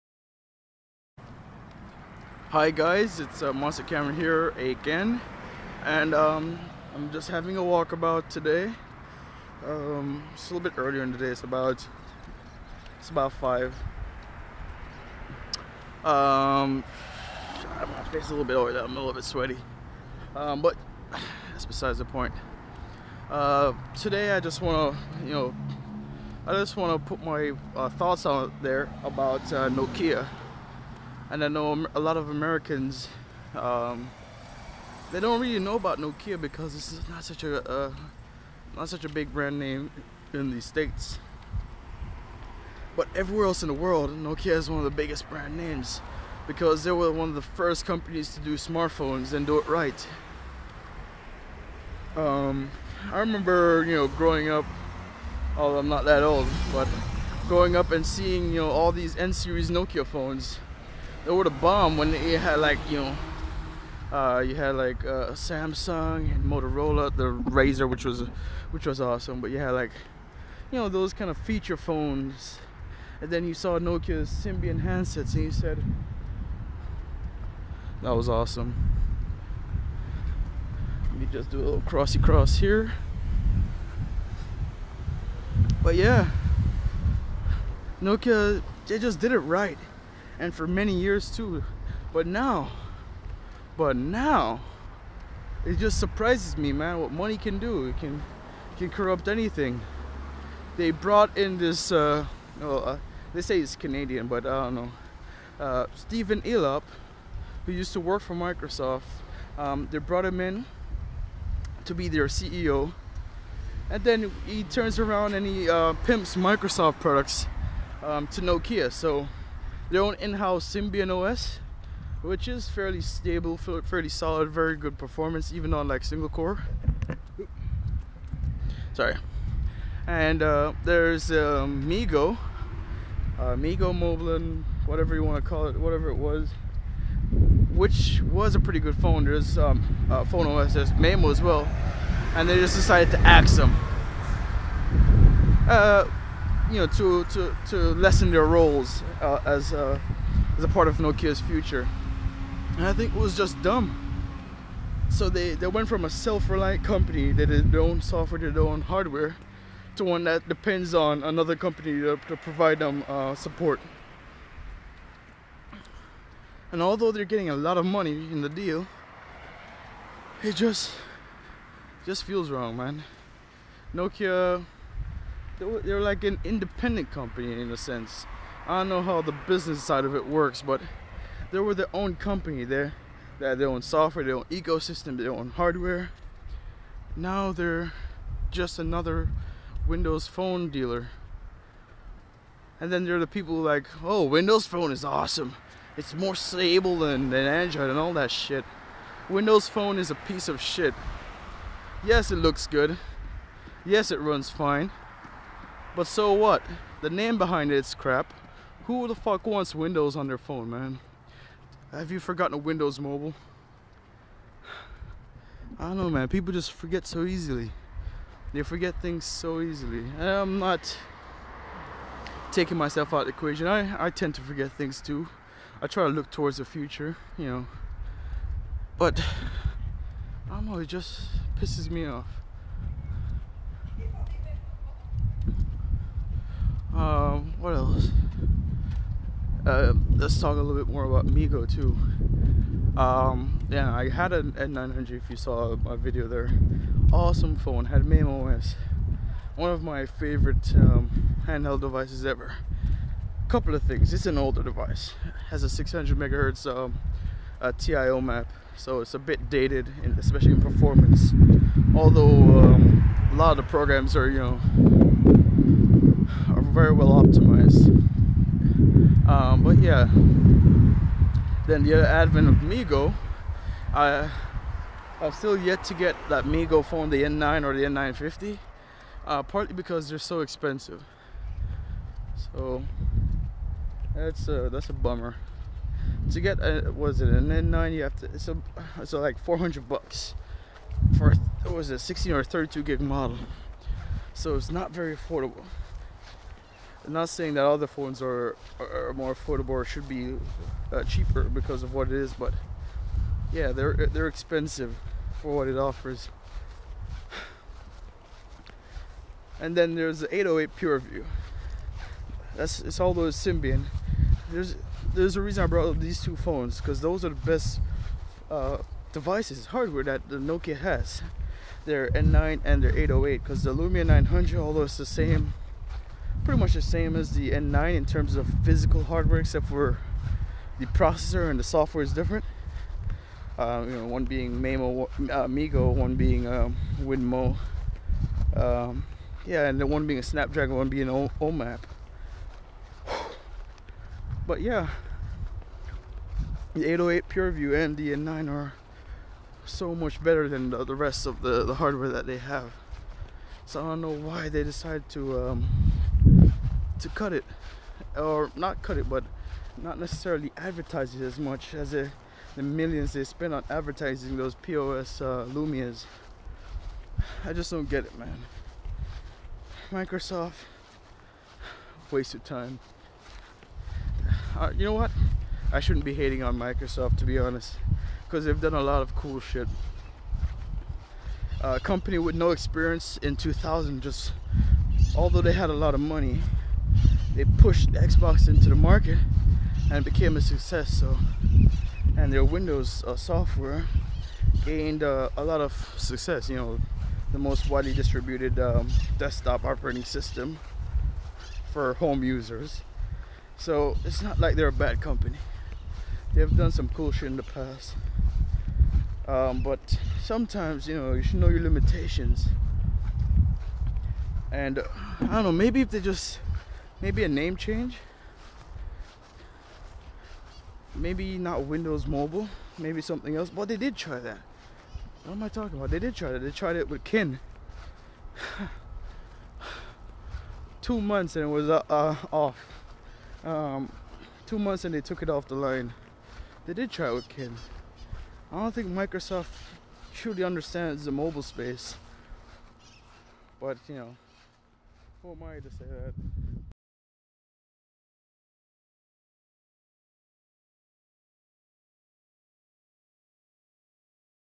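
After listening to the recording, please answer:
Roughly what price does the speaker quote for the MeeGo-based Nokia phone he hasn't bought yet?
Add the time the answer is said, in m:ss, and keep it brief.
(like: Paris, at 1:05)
$400, at 4:49.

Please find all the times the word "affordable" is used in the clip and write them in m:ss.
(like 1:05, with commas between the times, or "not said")
4:55, 4:59.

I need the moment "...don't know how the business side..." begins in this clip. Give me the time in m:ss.
2:58.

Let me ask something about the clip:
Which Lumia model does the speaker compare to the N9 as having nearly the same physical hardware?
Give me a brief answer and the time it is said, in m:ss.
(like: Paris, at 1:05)
Lumia 900, at 5:23.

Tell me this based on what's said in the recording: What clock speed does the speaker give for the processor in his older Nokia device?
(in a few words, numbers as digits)
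600 megahertz.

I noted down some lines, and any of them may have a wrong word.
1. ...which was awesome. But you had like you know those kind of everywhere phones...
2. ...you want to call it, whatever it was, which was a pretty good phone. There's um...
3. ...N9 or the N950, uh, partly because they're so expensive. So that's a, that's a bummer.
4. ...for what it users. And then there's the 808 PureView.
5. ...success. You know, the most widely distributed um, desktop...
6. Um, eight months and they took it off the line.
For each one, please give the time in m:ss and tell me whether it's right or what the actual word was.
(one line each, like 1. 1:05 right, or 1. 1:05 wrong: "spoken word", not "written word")
1. 1:08 wrong: "feature", not "everywhere"
2. 2:15 right
3. 4:37 right
4. 5:05 wrong: "offers", not "users"
5. 6:35 right
6. 7:13 wrong: "two", not "eight".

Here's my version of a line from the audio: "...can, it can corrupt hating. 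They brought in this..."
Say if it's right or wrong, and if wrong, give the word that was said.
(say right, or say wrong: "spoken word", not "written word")
wrong: "anything", not "hating".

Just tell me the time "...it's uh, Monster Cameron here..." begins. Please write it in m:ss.
0:03.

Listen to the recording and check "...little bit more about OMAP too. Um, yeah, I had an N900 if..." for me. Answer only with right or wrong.
wrong.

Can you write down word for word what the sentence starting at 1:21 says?
Let me just do a little crossy cross here.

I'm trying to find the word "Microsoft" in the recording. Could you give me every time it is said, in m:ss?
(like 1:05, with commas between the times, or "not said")
1:48, 1:56, 6:09, 6:16, 7:18.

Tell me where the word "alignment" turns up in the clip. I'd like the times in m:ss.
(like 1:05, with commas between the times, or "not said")
not said.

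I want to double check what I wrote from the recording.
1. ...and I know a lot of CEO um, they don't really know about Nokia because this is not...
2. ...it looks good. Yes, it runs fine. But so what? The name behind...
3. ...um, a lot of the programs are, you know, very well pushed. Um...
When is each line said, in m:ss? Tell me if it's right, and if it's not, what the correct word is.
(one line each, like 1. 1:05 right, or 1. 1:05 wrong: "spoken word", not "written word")
1. 0:31 wrong: "Americans", not "CEO"
2. 3:22 right
3. 4:22 wrong: "optimized", not "pushed".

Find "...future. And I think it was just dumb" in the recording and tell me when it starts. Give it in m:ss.
2:31.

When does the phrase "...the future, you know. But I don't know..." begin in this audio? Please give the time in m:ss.
3:46.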